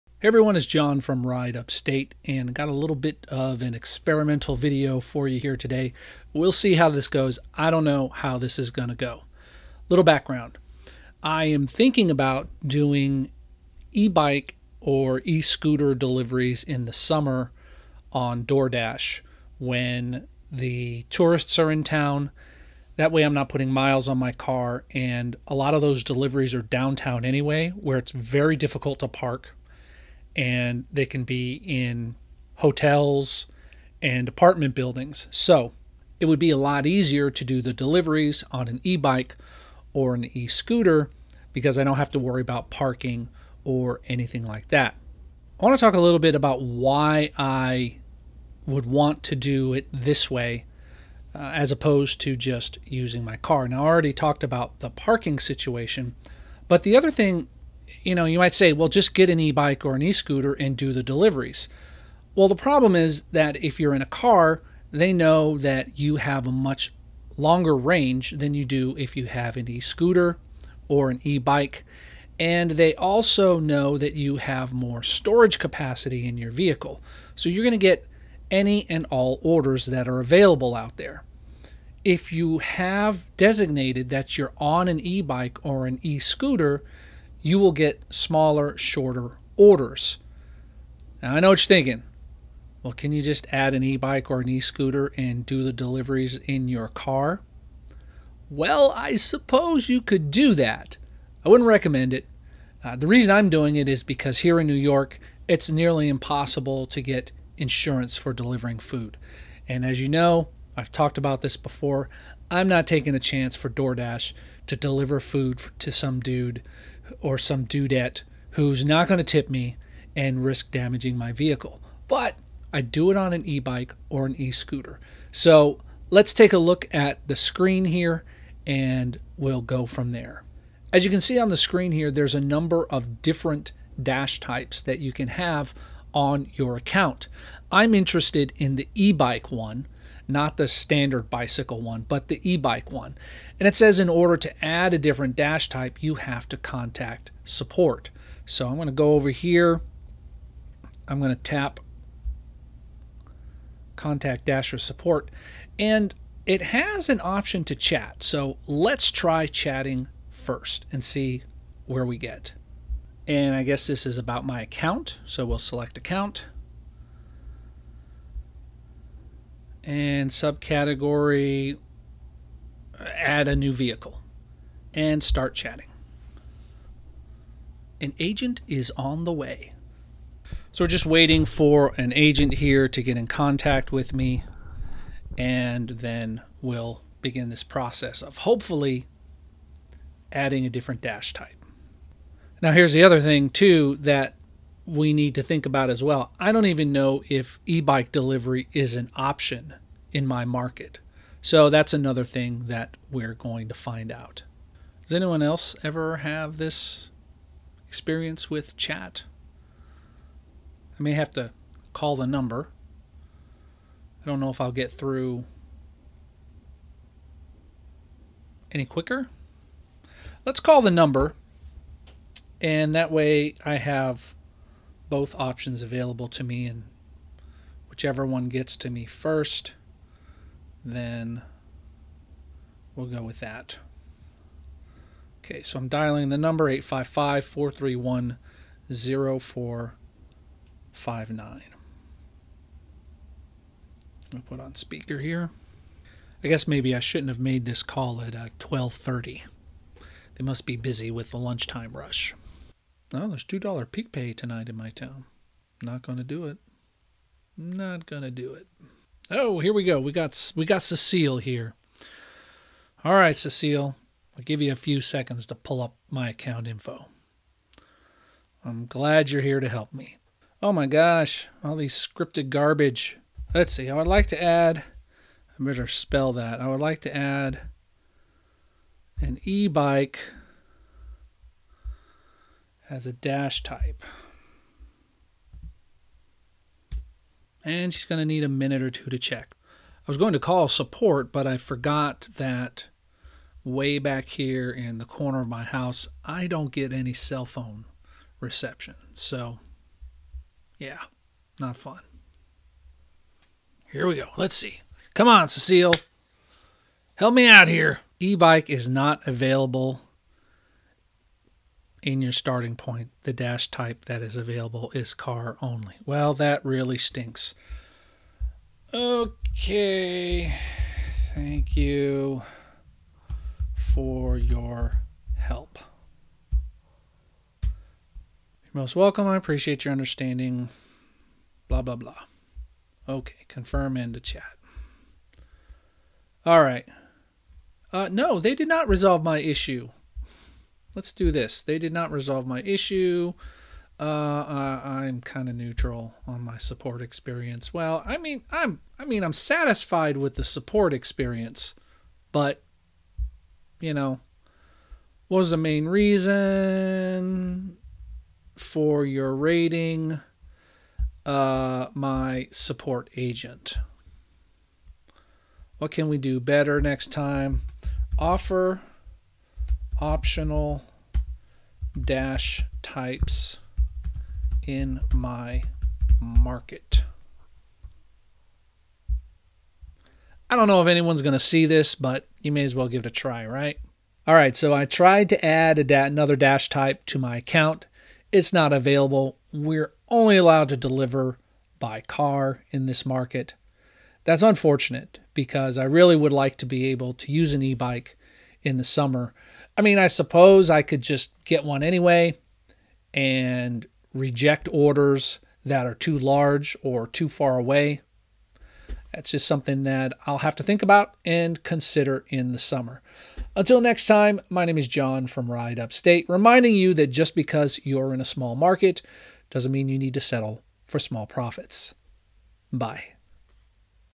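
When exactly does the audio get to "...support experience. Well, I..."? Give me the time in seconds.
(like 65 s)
346 s.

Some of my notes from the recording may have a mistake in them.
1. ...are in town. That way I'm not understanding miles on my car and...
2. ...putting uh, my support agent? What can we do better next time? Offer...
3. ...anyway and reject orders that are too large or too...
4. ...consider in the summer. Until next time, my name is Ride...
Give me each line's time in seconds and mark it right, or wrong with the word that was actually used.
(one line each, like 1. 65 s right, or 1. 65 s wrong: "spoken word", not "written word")
1. 21 s wrong: "putting", not "understanding"
2. 359 s wrong: "rating", not "putting"
3. 401 s right
4. 411 s wrong: "John", not "Ride".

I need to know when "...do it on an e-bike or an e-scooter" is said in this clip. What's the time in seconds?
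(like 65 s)
122 s.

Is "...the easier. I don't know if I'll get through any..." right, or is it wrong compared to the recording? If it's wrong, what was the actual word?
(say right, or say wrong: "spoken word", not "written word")
wrong: "number", not "easier".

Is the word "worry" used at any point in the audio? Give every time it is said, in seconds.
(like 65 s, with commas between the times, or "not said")
42 s.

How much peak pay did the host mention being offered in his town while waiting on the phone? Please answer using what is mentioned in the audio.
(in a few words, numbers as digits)
$2.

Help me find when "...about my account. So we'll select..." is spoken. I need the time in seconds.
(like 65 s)
164 s.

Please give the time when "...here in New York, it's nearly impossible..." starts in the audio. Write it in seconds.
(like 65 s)
104 s.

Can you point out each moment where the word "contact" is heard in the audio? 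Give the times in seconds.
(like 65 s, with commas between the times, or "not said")
146 s, 153 s, 183 s.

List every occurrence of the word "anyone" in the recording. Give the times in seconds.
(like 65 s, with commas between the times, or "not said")
205 s, 380 s.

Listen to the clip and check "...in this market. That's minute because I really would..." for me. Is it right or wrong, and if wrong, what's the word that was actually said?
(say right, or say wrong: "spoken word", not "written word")
wrong: "unfortunate", not "minute".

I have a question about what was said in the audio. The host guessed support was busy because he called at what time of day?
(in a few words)
12:30.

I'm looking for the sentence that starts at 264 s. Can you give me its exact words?
I'll give you a few seconds to pull up my account info.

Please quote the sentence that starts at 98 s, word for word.
Well, I suppose you could do that.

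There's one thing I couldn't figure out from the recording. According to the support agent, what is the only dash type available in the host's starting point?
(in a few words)
car only.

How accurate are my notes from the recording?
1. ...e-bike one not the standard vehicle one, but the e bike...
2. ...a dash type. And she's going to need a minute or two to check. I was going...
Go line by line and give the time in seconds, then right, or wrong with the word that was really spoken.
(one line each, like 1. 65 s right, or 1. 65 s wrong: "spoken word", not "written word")
1. 138 s wrong: "bicycle", not "vehicle"
2. 283 s right.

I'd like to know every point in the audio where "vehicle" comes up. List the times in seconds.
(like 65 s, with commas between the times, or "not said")
76 s, 121 s, 173 s.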